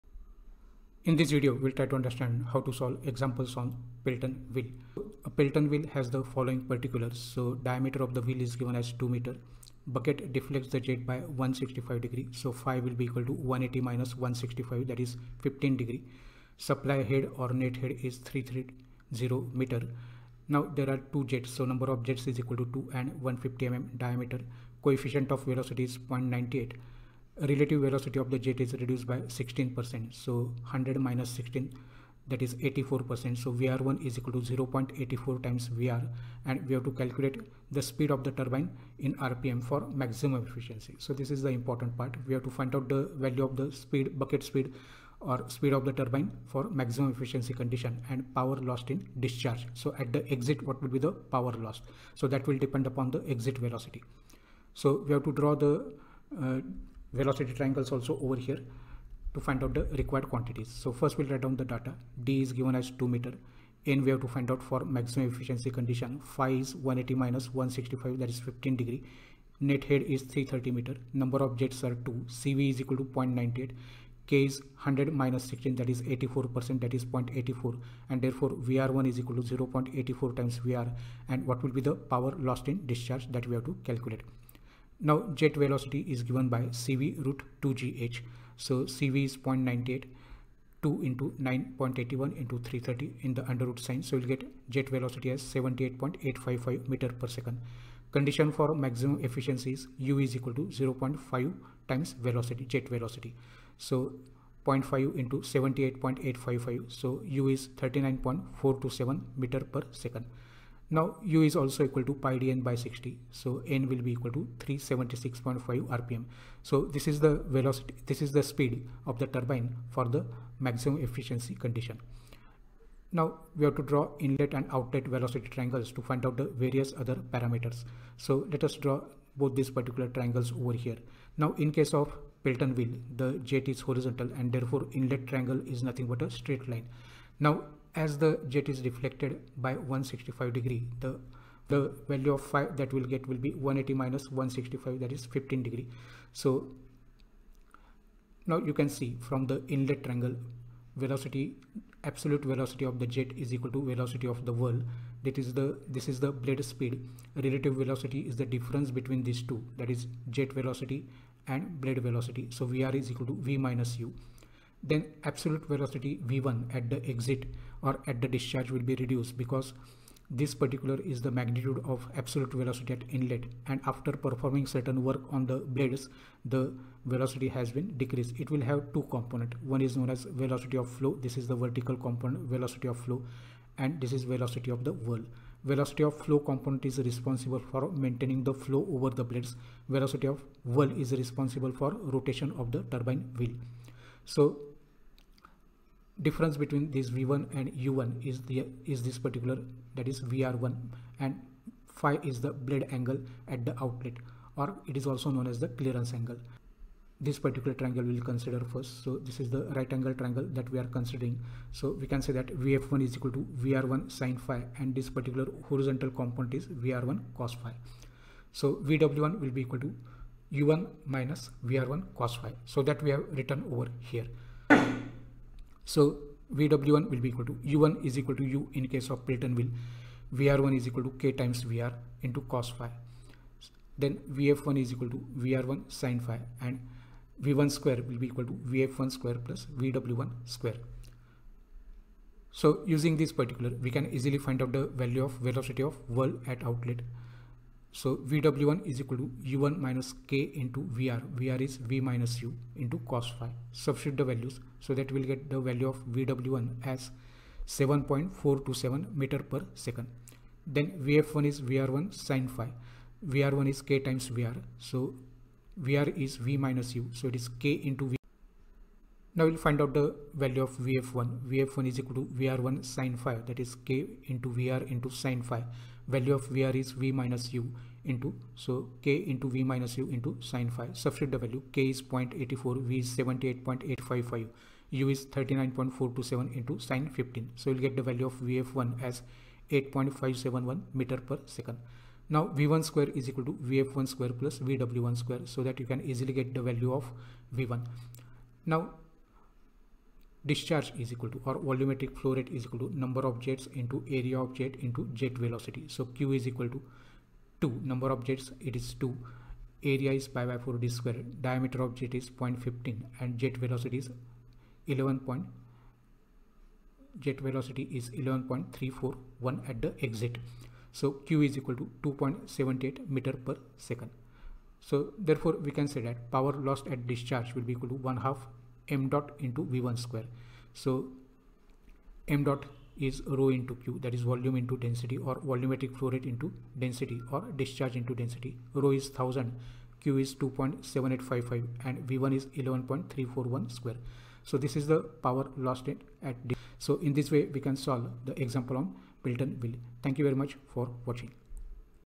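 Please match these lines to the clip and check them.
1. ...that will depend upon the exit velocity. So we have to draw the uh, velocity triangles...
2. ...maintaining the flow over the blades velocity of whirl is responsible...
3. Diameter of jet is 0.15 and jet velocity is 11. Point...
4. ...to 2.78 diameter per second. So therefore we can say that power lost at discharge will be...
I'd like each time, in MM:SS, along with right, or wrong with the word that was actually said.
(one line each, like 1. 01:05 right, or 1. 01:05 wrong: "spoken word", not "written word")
1. 00:52 right
2. 03:07 right
3. 05:11 right
4. 05:21 wrong: "meter", not "diameter".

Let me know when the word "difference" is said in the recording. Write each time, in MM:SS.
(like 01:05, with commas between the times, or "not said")
02:38, 03:16.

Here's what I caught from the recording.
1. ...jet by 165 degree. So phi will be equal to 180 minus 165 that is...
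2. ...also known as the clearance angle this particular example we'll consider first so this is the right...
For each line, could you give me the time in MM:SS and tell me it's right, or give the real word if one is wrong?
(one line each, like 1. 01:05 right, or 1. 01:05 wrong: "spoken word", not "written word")
1. 00:10 right
2. 03:25 wrong: "triangle", not "example".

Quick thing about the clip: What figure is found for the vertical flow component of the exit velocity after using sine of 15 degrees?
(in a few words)
8.571 m/s.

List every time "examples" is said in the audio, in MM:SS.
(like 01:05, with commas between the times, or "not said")
00:03, 05:48.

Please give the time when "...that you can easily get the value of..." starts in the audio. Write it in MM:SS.
04:55.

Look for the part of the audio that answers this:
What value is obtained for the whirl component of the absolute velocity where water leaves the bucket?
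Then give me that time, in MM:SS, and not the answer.
04:17.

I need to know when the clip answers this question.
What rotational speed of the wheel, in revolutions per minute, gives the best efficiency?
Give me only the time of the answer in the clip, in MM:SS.
01:54.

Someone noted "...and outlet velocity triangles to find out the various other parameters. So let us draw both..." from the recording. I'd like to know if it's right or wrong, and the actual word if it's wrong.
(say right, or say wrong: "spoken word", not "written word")
right.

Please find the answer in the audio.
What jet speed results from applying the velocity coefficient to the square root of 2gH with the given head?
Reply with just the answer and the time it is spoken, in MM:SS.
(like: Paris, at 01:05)
78.855 m/s, at 01:35.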